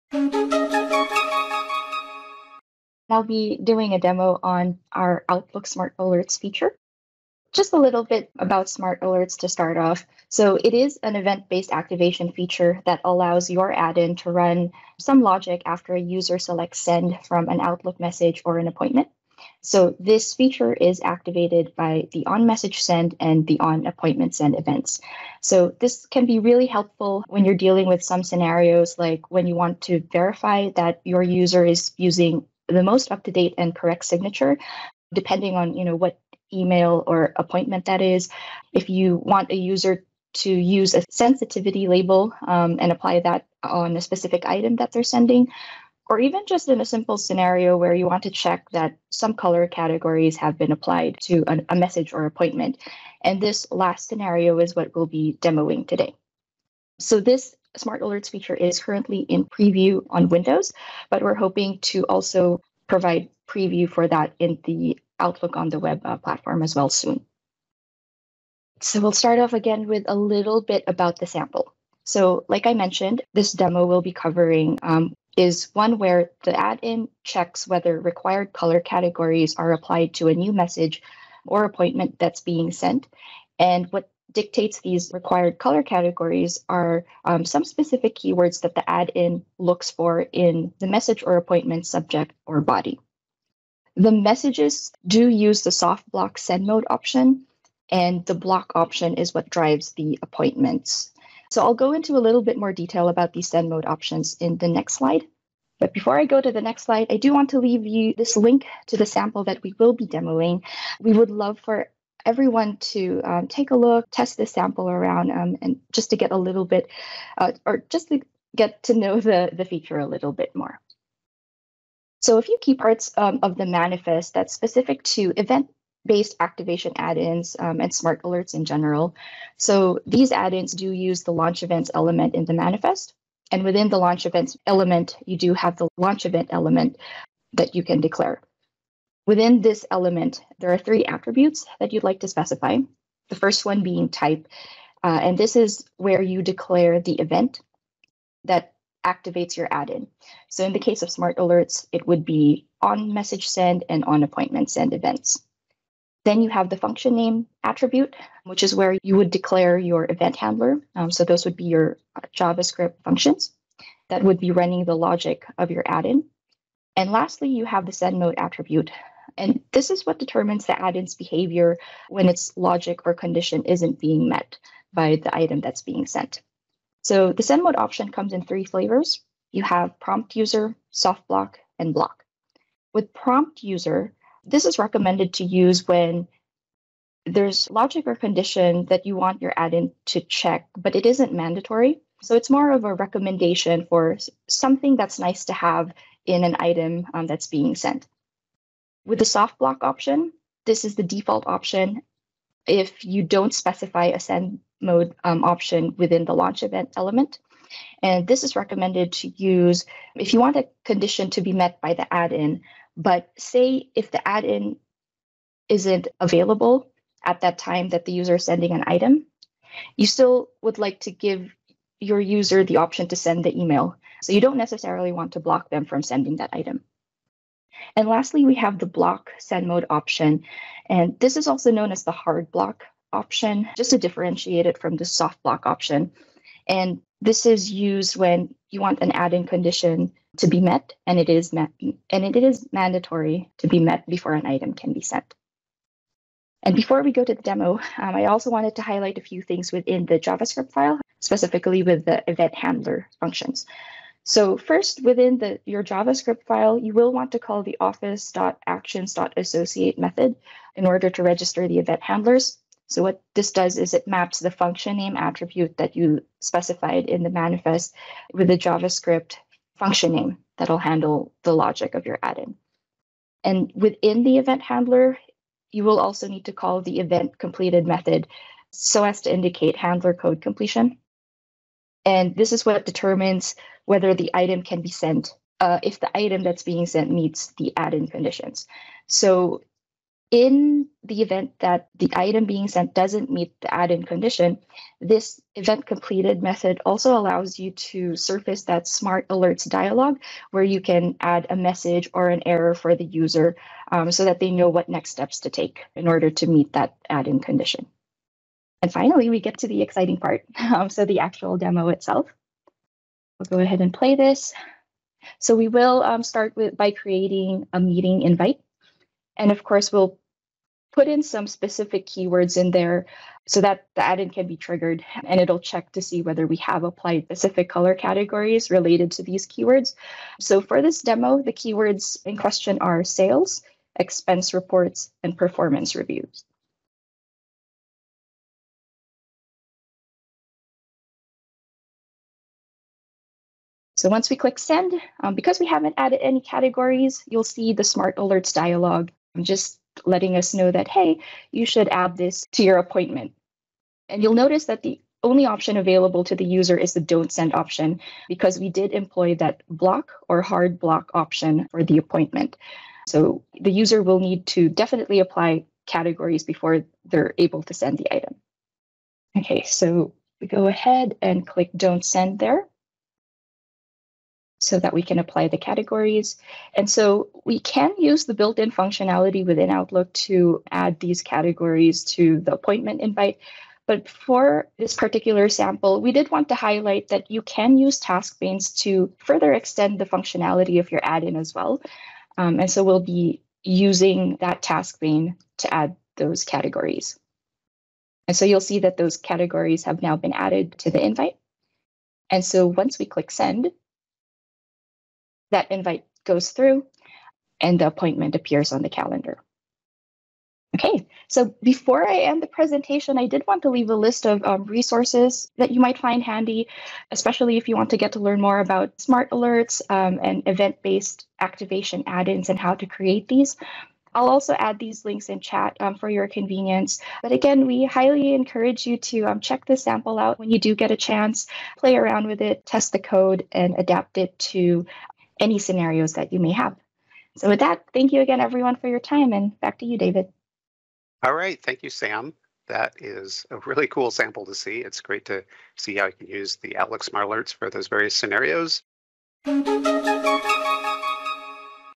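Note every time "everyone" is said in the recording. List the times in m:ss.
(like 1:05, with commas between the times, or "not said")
1:52, 7:18.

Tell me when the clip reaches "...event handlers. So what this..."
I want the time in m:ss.
4:21.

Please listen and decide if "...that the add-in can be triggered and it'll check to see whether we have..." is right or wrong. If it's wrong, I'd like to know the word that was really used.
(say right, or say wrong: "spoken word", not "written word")
right.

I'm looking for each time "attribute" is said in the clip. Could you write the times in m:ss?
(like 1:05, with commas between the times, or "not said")
2:21, 2:37, 2:48, 4:25.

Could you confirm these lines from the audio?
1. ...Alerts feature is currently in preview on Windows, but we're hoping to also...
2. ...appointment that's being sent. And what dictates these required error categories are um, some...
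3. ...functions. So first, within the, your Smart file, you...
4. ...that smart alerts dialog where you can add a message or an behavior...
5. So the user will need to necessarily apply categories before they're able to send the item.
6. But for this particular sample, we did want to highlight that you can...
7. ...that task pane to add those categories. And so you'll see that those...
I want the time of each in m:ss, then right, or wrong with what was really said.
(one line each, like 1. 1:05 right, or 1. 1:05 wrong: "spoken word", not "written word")
1. 0:58 right
2. 1:21 wrong: "color", not "error"
3. 4:13 wrong: "JavaScript", not "Smart"
4. 4:58 wrong: "error", not "behavior"
5. 6:03 wrong: "definitely", not "necessarily"
6. 6:23 right
7. 6:34 right.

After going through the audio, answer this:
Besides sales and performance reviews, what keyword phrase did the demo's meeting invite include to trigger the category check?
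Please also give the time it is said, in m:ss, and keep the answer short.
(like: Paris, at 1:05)
expense reports, at 5:33.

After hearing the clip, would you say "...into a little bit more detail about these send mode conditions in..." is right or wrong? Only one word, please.
wrong.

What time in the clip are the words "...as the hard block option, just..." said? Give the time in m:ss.
3:51.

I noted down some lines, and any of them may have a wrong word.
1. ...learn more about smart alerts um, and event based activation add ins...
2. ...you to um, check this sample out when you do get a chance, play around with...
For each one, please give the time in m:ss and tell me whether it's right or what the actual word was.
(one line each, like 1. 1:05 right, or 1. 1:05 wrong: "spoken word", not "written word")
1. 6:58 right
2. 7:08 right.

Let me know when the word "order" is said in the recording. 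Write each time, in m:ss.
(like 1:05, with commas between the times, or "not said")
4:20, 5:06.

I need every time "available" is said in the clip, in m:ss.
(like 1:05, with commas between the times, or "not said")
3:36, 5:55.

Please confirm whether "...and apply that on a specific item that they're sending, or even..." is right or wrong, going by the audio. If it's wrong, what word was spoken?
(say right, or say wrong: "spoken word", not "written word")
right.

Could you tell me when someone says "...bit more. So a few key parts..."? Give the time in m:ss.
2:00.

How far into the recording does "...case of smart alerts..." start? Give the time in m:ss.
2:30.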